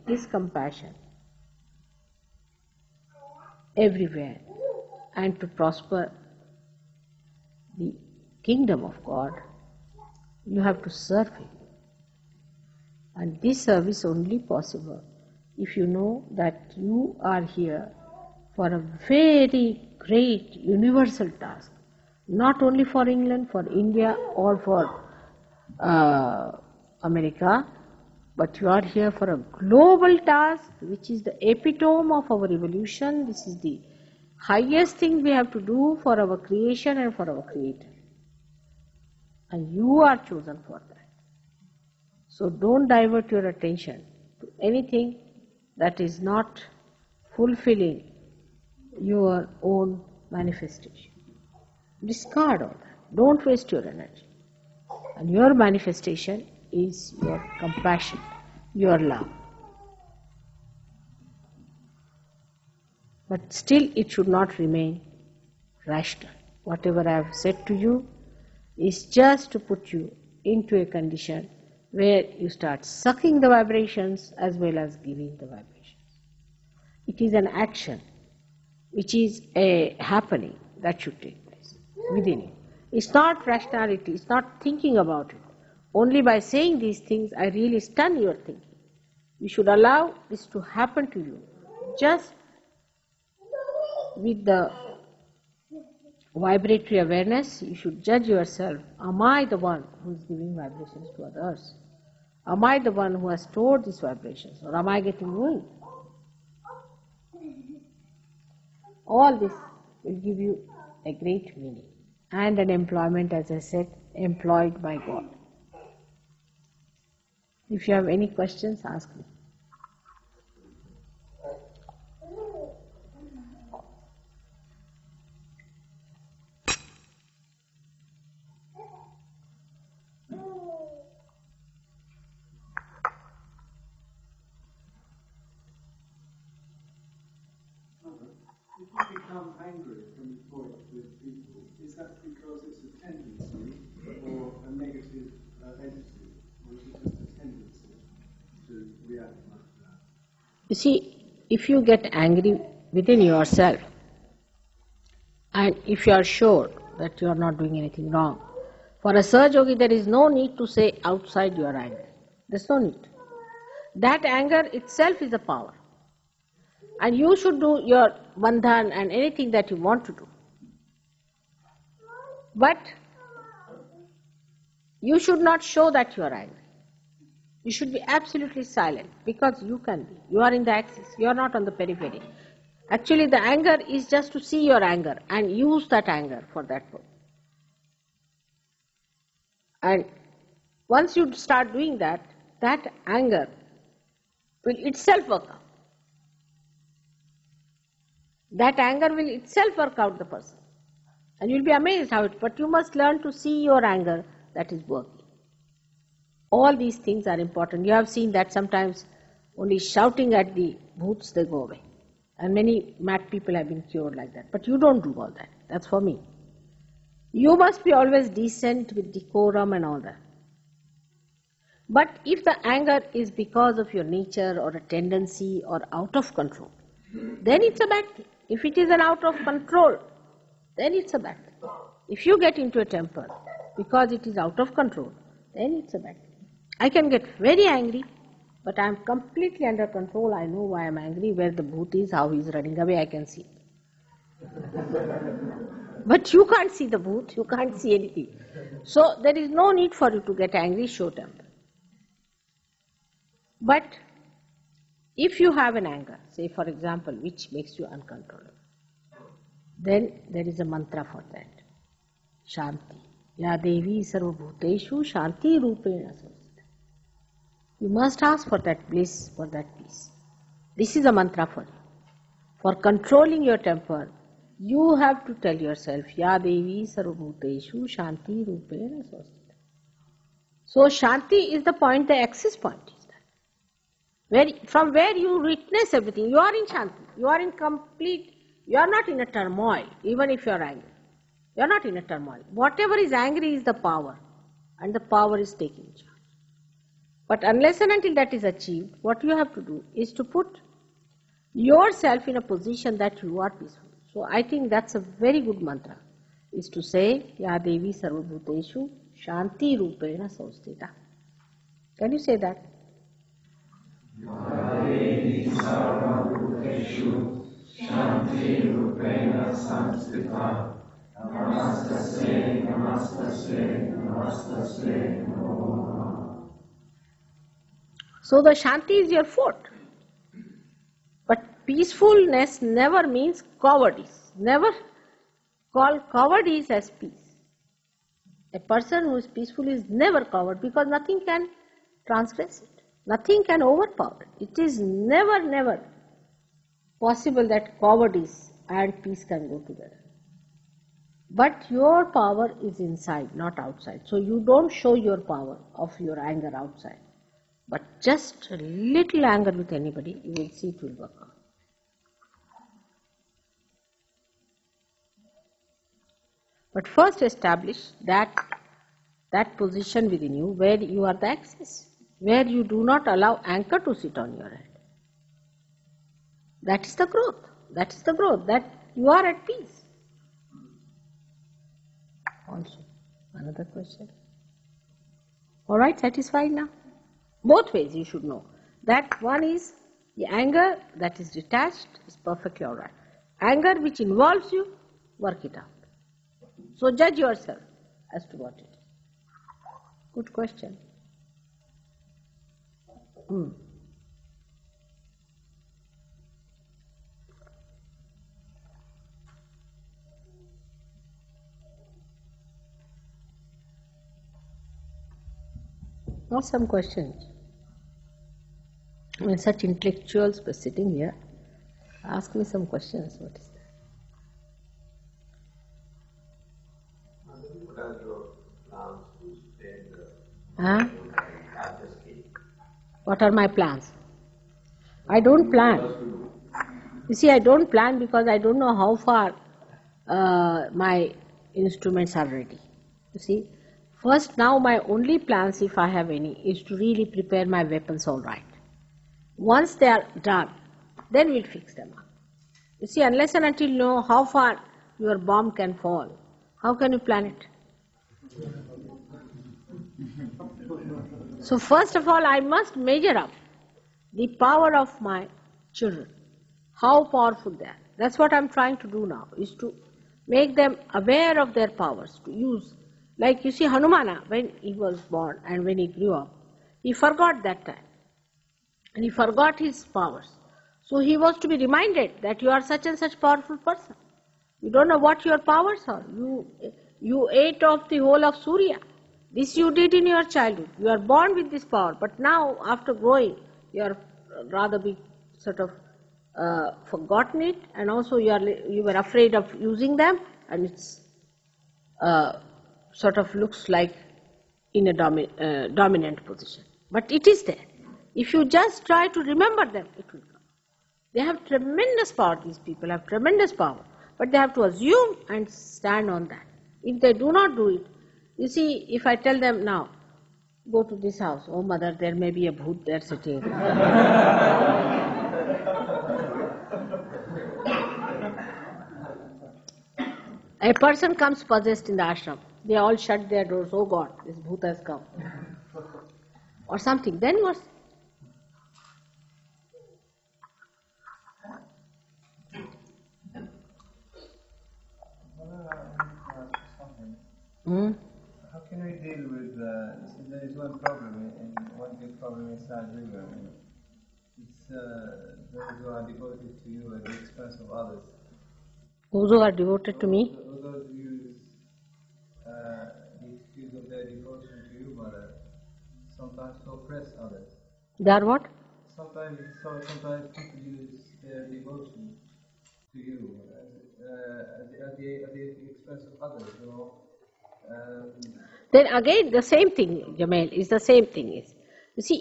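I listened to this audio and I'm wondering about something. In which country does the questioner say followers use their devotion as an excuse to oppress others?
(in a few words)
Nigeria.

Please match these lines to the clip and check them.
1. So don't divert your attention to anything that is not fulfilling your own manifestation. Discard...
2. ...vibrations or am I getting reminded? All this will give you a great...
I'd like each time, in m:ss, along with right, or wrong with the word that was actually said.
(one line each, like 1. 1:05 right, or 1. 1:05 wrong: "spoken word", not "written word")
1. 0:42 right
2. 1:43 wrong: "ruined", not "reminded".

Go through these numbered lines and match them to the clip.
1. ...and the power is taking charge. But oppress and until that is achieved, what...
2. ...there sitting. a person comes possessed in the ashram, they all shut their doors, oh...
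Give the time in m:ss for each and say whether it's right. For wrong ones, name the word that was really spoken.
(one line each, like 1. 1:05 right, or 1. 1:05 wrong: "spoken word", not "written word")
1. 4:54 wrong: "unless", not "oppress"
2. 8:42 right.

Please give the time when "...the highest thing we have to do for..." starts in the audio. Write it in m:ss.
0:33.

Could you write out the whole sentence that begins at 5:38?
A person who is peaceful is never coward because nothing can transgress it.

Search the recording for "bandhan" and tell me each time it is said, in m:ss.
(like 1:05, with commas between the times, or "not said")
2:48.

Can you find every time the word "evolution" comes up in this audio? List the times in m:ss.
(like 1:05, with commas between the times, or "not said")
0:32.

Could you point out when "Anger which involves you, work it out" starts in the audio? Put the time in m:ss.
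6:33.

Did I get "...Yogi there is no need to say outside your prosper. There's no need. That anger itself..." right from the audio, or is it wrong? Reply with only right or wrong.
wrong.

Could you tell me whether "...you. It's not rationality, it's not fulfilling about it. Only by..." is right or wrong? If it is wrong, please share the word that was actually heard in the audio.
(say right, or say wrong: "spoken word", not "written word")
wrong: "thinking", not "fulfilling".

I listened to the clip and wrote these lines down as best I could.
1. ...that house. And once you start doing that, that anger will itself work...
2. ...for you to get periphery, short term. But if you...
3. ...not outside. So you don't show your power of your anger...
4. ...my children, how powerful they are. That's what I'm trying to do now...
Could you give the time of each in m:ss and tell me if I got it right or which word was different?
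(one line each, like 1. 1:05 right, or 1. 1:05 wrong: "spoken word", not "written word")
1. 3:06 wrong: "purpose", not "house"
2. 4:09 wrong: "angry", not "periphery"
3. 5:53 right
4. 7:44 right.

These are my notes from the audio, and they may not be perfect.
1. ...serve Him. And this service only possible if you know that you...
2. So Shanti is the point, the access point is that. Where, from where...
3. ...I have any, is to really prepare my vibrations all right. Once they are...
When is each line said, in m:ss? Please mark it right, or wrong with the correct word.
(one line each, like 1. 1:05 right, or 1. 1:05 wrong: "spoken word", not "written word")
1. 0:10 right
2. 4:40 right
3. 7:25 wrong: "weapons", not "vibrations".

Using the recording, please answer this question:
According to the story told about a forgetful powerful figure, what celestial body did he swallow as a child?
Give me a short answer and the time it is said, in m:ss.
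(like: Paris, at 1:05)
Surya, at 8:08.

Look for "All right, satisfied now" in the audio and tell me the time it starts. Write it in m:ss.
6:25.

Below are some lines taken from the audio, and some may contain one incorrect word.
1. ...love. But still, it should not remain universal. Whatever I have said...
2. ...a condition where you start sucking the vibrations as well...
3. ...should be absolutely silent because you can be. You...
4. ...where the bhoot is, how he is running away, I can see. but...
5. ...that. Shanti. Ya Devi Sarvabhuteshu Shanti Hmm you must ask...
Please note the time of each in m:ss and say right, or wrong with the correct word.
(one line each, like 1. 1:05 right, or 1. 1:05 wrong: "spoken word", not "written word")
1. 0:58 wrong: "rational", not "universal"
2. 1:10 right
3. 2:57 right
4. 4:01 right
5. 4:21 wrong: "Rupena", not "Hmm".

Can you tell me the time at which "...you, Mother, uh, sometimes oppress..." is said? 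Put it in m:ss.
9:24.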